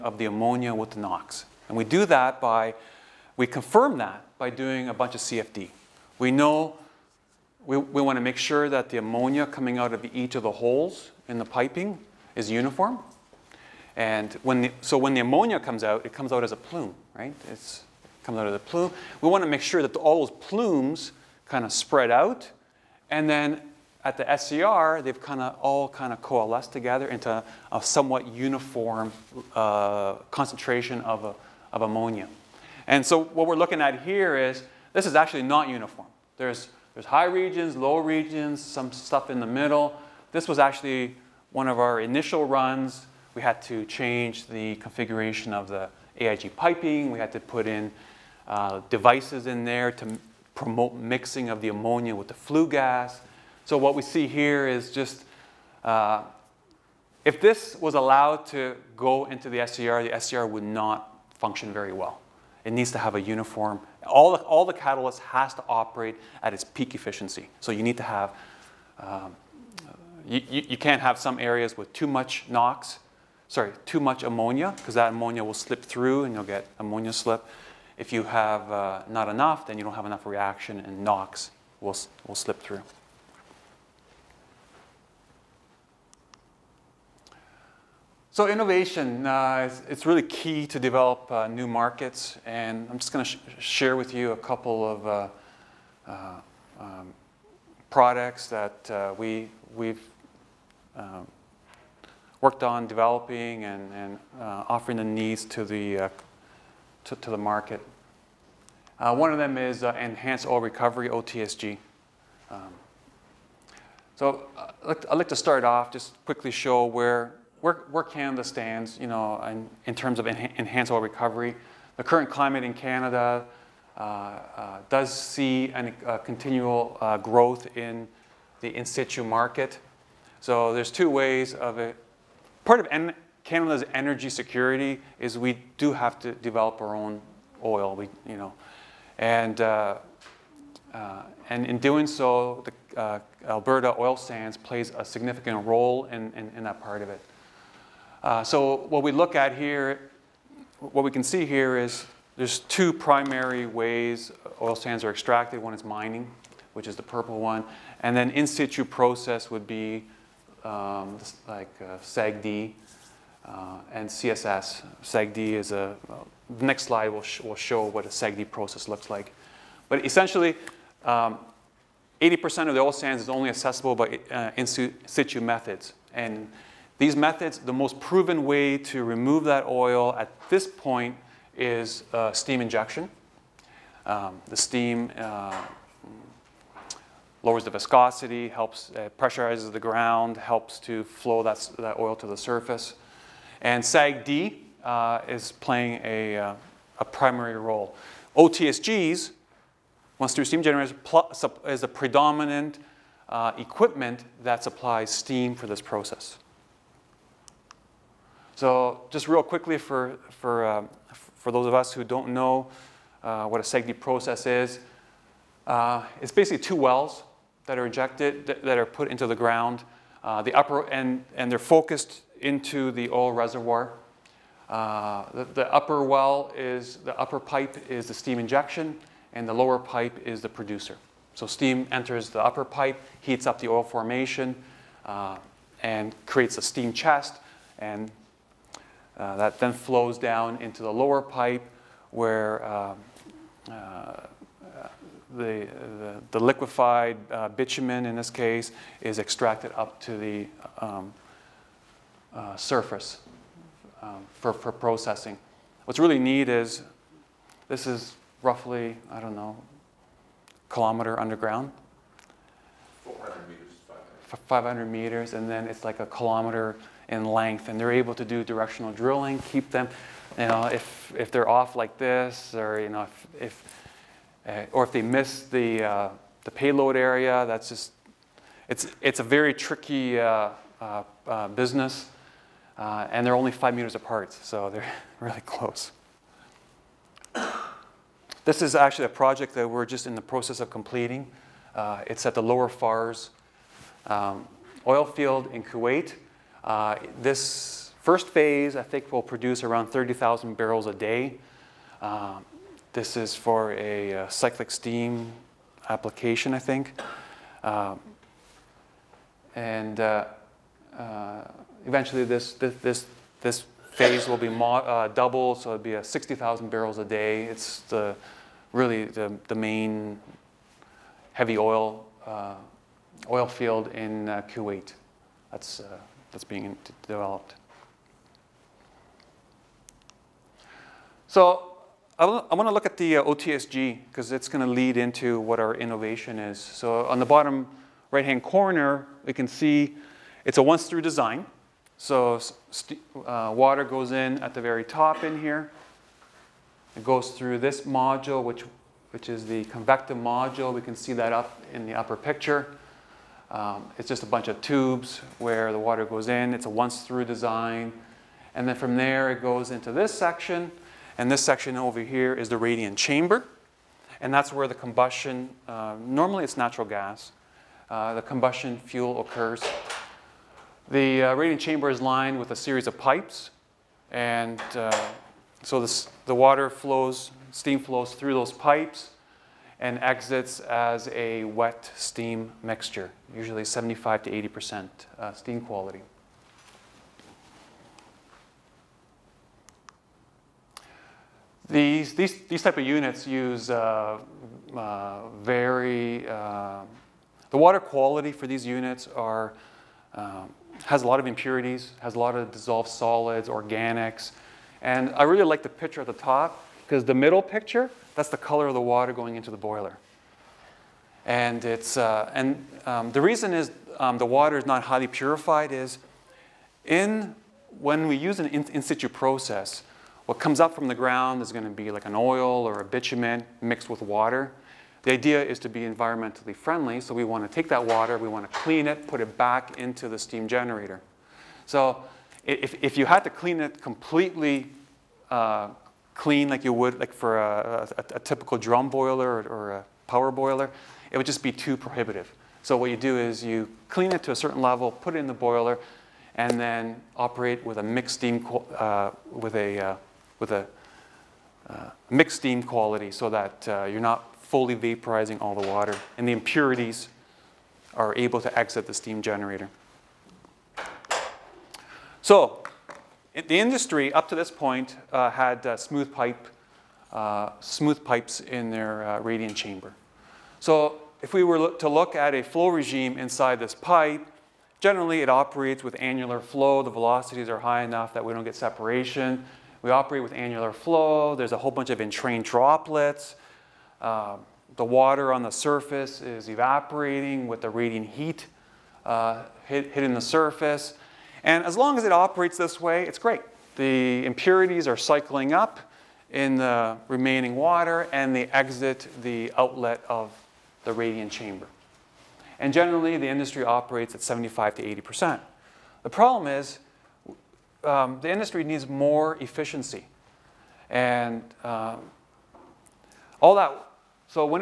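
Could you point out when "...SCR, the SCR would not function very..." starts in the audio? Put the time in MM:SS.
00:59.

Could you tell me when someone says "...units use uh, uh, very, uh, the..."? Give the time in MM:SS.
06:32.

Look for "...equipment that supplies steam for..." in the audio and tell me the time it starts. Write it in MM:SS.
03:23.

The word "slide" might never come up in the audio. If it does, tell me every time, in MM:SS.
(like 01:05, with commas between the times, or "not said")
02:46.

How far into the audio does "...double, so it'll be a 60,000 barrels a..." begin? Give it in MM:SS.
05:15.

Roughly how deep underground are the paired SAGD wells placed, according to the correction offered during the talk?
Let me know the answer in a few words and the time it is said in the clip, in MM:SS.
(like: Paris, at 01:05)
500 meters, at 04:24.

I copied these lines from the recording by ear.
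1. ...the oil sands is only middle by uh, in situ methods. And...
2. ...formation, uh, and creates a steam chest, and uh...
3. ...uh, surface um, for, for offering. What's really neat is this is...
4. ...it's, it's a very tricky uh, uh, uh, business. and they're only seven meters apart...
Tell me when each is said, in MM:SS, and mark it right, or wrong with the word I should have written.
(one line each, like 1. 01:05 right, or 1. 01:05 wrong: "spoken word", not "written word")
1. 02:52 wrong: "accessible", not "middle"
2. 03:53 right
3. 04:12 wrong: "processing", not "offering"
4. 04:38 wrong: "five", not "seven".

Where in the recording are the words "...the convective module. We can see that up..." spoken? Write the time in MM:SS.
05:49.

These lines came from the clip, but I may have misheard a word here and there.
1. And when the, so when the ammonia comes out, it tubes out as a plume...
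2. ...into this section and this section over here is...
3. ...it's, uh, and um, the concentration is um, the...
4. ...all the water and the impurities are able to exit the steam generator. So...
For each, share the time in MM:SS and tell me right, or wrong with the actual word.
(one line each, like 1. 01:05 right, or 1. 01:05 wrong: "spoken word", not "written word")
1. 00:13 wrong: "comes", not "tubes"
2. 05:59 right
3. 06:51 wrong: "reason", not "concentration"
4. 07:35 right.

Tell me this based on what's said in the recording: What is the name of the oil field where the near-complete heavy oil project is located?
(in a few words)
Lower Fars.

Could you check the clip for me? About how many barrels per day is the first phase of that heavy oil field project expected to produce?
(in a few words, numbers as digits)
30,000.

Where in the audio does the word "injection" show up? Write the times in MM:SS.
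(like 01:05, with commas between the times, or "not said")
03:02, 03:48.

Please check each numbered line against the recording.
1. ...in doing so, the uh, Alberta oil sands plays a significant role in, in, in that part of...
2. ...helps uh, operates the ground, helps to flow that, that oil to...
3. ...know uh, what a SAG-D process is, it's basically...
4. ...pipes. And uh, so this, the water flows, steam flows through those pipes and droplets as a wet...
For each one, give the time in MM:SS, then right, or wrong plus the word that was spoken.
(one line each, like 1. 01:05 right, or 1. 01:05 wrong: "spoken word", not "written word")
1. 02:21 right
2. 03:08 wrong: "pressurizes", not "operates"
3. 03:32 right
4. 06:12 wrong: "exits", not "droplets".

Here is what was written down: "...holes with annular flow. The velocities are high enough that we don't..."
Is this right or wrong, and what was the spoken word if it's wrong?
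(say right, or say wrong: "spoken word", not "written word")
wrong: "operates", not "holes".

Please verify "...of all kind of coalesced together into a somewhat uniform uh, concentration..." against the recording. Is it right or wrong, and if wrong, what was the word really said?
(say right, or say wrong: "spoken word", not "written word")
right.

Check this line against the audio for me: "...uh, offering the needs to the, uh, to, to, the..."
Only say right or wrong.
right.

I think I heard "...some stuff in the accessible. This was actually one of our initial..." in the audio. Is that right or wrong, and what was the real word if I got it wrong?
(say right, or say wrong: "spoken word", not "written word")
wrong: "middle", not "accessible".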